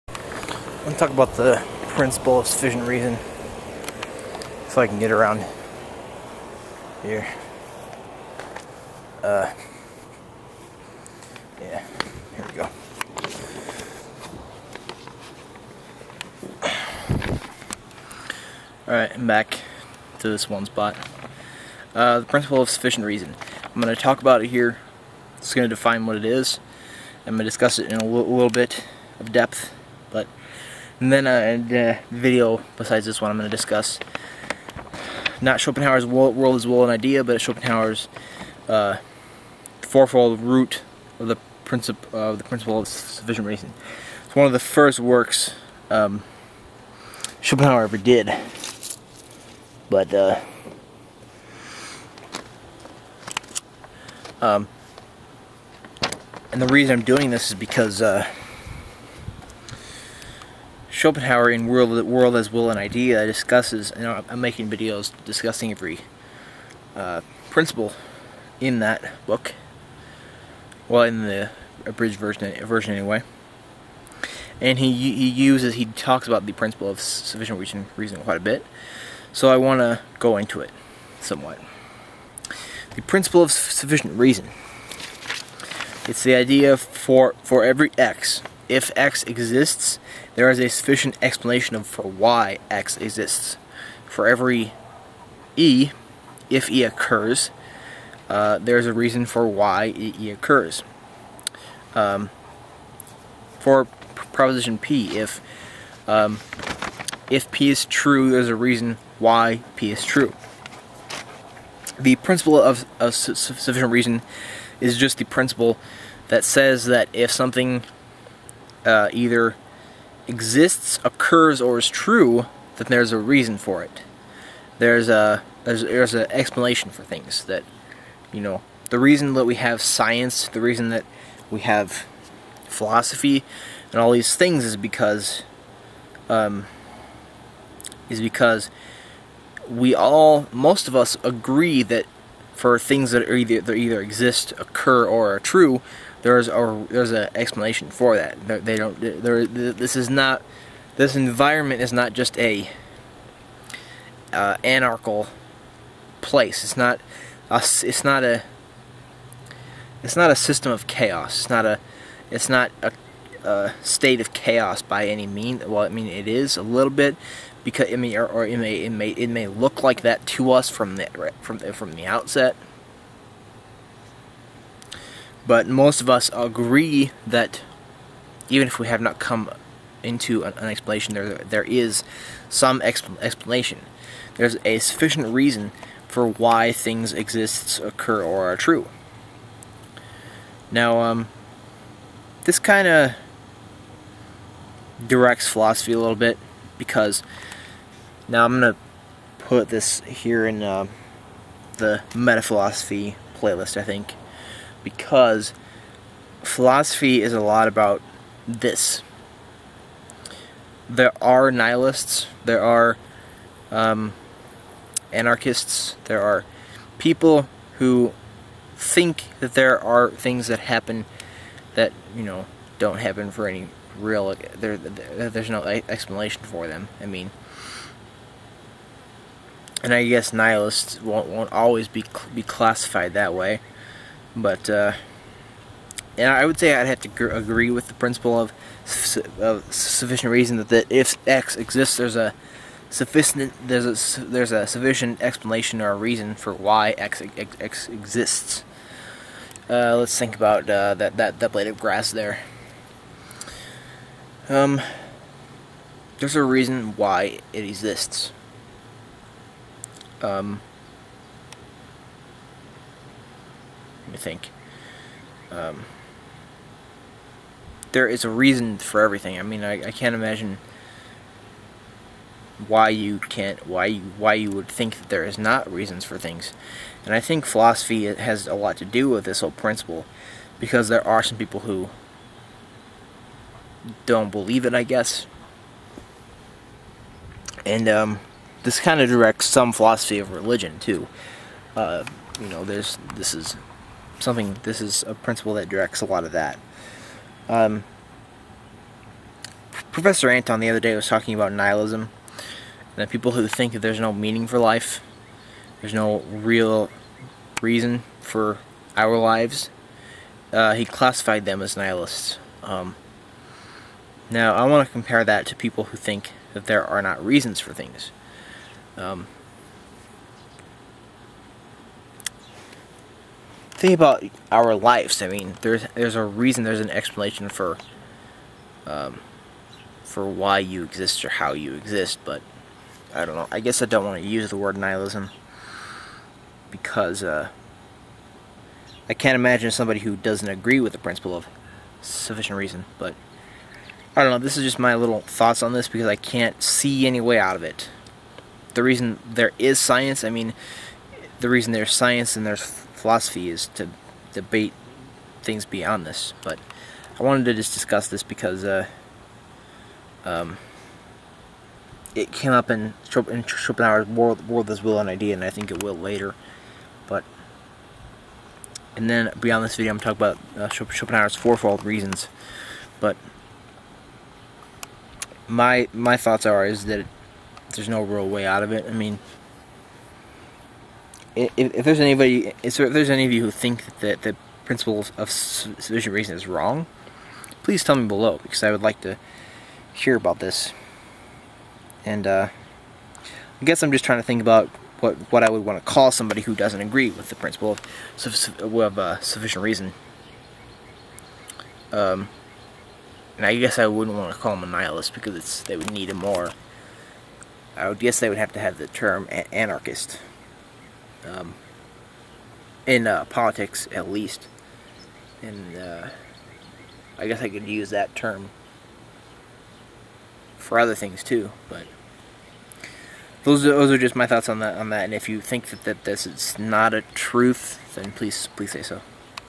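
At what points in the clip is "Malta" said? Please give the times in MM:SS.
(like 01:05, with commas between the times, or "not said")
not said.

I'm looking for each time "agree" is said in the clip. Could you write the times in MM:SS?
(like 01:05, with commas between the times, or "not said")
02:21, 02:56, 03:57, 05:40, 06:36.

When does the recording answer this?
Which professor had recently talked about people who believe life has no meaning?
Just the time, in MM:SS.
04:59.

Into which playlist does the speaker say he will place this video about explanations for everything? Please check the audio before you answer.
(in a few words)
meta philosophy.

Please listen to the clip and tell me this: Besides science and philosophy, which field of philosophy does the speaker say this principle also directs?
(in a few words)
philosophy of religion.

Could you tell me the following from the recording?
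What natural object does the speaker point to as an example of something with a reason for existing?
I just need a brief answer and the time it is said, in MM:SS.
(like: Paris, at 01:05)
blade of grass, at 04:11.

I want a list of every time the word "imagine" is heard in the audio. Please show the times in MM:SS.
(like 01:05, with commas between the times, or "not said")
04:30, 05:39.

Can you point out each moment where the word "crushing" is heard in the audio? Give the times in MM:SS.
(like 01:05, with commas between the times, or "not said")
not said.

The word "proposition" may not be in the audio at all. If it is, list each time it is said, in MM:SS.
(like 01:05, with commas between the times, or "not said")
01:44.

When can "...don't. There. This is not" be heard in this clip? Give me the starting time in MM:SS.
02:28.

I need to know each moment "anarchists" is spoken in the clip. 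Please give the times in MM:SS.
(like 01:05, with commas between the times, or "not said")
03:35, 06:49.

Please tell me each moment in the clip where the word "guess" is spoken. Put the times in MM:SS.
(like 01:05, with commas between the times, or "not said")
03:50, 04:44, 05:33, 06:33, 06:43, 06:47, 06:57.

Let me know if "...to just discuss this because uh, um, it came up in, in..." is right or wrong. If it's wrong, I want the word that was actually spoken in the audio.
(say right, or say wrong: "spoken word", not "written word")
right.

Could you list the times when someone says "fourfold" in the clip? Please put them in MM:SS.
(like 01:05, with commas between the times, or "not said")
00:39, 06:11.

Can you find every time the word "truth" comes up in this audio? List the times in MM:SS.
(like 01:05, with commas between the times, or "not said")
07:07.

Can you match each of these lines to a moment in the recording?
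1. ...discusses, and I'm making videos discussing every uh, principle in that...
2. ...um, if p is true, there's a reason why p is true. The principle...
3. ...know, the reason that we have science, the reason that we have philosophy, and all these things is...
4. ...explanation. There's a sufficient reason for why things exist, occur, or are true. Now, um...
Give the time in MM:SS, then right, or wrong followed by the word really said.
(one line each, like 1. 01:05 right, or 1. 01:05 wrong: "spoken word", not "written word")
1. 01:03 right
2. 01:46 right
3. 02:08 right
4. 03:03 right.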